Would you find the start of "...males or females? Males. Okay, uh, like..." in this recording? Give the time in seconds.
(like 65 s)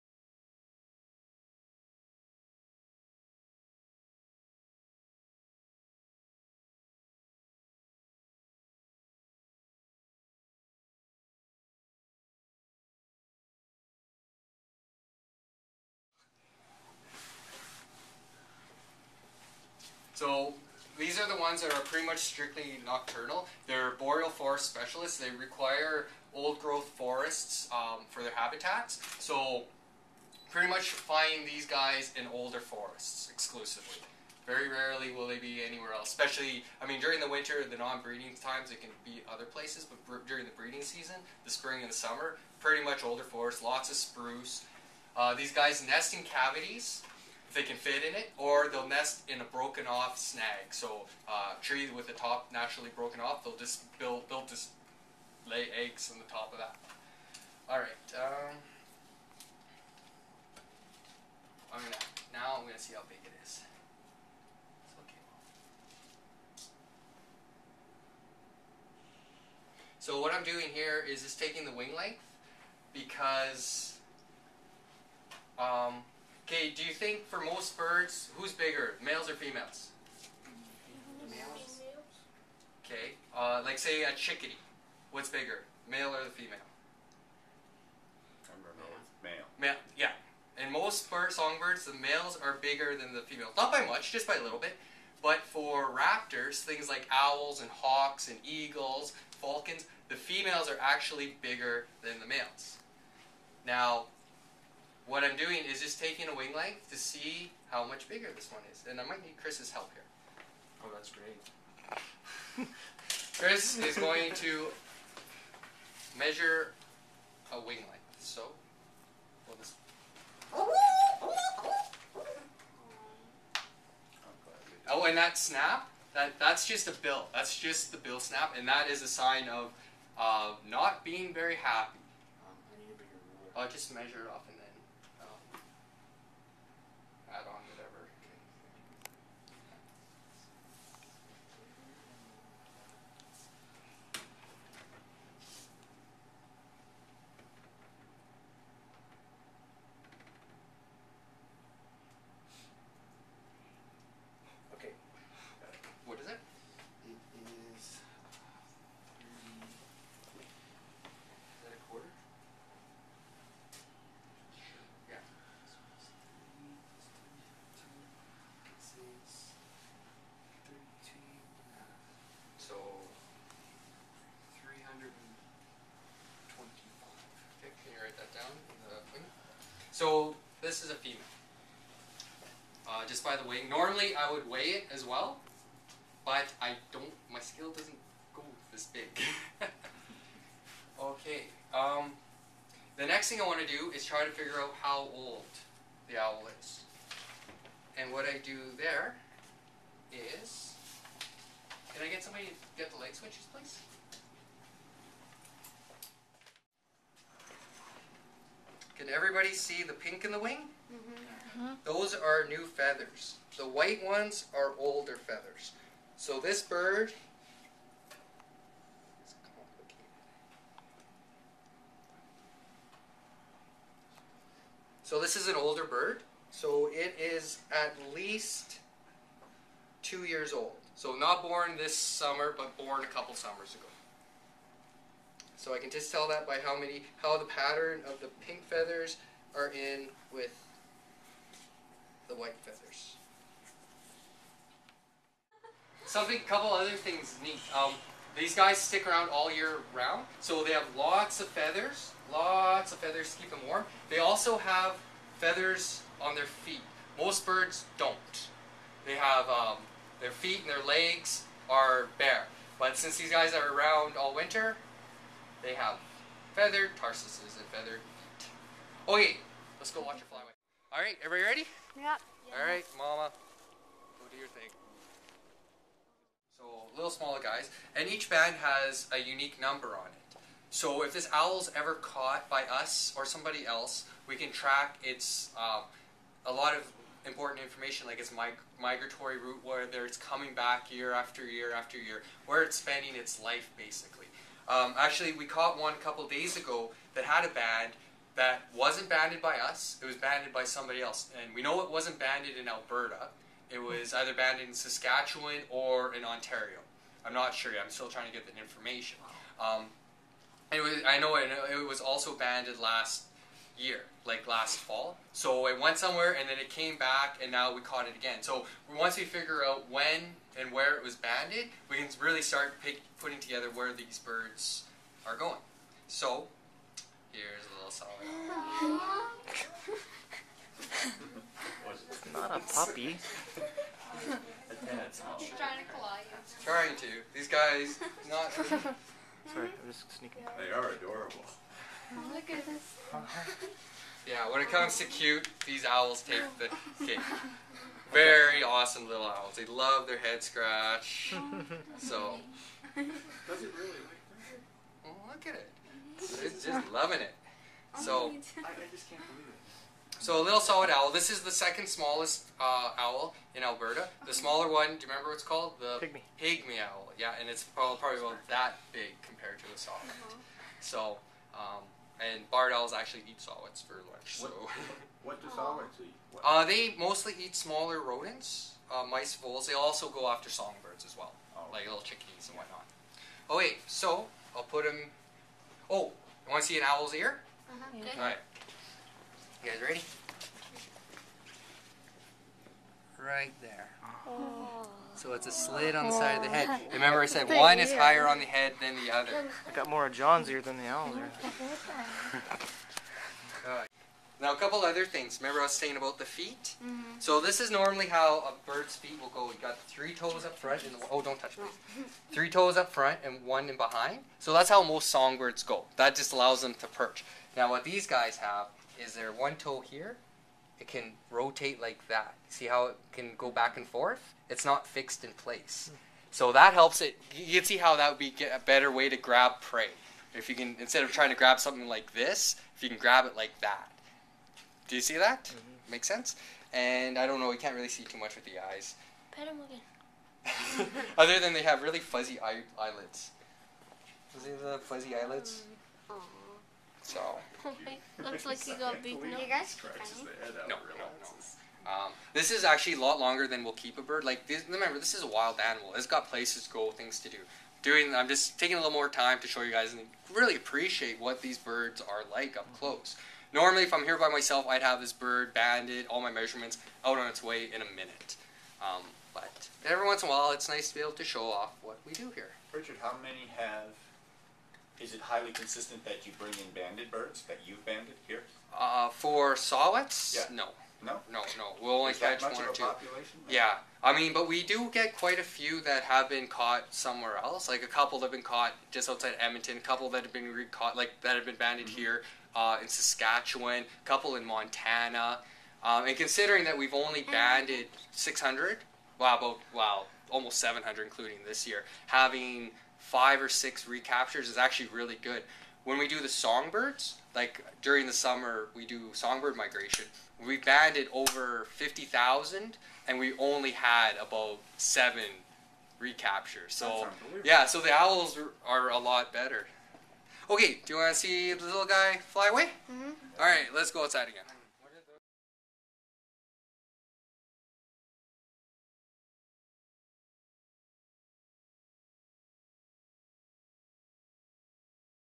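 79 s.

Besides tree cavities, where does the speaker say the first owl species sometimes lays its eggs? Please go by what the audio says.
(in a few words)
broken off snag.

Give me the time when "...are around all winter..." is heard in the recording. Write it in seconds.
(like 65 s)
263 s.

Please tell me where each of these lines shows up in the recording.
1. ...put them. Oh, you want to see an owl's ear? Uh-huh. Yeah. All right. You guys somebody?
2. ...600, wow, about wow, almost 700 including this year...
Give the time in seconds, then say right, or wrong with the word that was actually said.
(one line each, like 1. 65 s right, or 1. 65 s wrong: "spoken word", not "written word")
1. 384 s wrong: "ready", not "somebody"
2. 498 s right.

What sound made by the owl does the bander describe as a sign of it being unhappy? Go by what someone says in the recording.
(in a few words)
bill snap.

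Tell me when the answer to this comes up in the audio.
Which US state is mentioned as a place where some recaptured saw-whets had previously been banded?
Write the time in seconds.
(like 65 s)
494 s.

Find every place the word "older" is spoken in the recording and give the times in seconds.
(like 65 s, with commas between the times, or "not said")
32 s, 43 s, 214 s, 225 s.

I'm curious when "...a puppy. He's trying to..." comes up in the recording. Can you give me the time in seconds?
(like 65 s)
332 s.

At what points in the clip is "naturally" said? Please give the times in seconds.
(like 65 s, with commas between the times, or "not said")
52 s.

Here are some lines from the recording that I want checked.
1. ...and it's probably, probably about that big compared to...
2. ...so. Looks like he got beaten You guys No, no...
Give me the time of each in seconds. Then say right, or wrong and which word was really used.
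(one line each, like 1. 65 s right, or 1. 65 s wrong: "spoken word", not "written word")
1. 367 s right
2. 447 s right.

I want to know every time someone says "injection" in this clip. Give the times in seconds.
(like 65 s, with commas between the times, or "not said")
not said.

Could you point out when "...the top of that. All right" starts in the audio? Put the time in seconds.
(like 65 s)
56 s.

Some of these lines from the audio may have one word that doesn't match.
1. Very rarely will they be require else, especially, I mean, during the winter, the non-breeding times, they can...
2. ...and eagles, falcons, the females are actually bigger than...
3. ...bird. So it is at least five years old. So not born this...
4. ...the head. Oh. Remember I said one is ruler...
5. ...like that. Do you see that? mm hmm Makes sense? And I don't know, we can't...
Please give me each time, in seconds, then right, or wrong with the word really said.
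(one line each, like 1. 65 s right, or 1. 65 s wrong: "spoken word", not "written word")
1. 34 s wrong: "anywhere", not "require"
2. 98 s right
3. 225 s wrong: "two", not "five"
4. 396 s wrong: "higher", not "ruler"
5. 433 s right.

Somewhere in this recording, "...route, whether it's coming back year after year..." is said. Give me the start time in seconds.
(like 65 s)
289 s.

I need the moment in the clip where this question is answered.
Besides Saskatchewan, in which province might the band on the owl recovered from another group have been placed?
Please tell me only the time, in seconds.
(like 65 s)
306 s.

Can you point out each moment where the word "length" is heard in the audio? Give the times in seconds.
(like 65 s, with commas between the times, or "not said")
71 s, 106 s, 117 s.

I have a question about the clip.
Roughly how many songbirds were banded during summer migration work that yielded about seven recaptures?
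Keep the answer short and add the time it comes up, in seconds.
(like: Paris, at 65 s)
over 50,000, at 511 s.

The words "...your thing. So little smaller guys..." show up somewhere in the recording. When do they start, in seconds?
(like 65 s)
274 s.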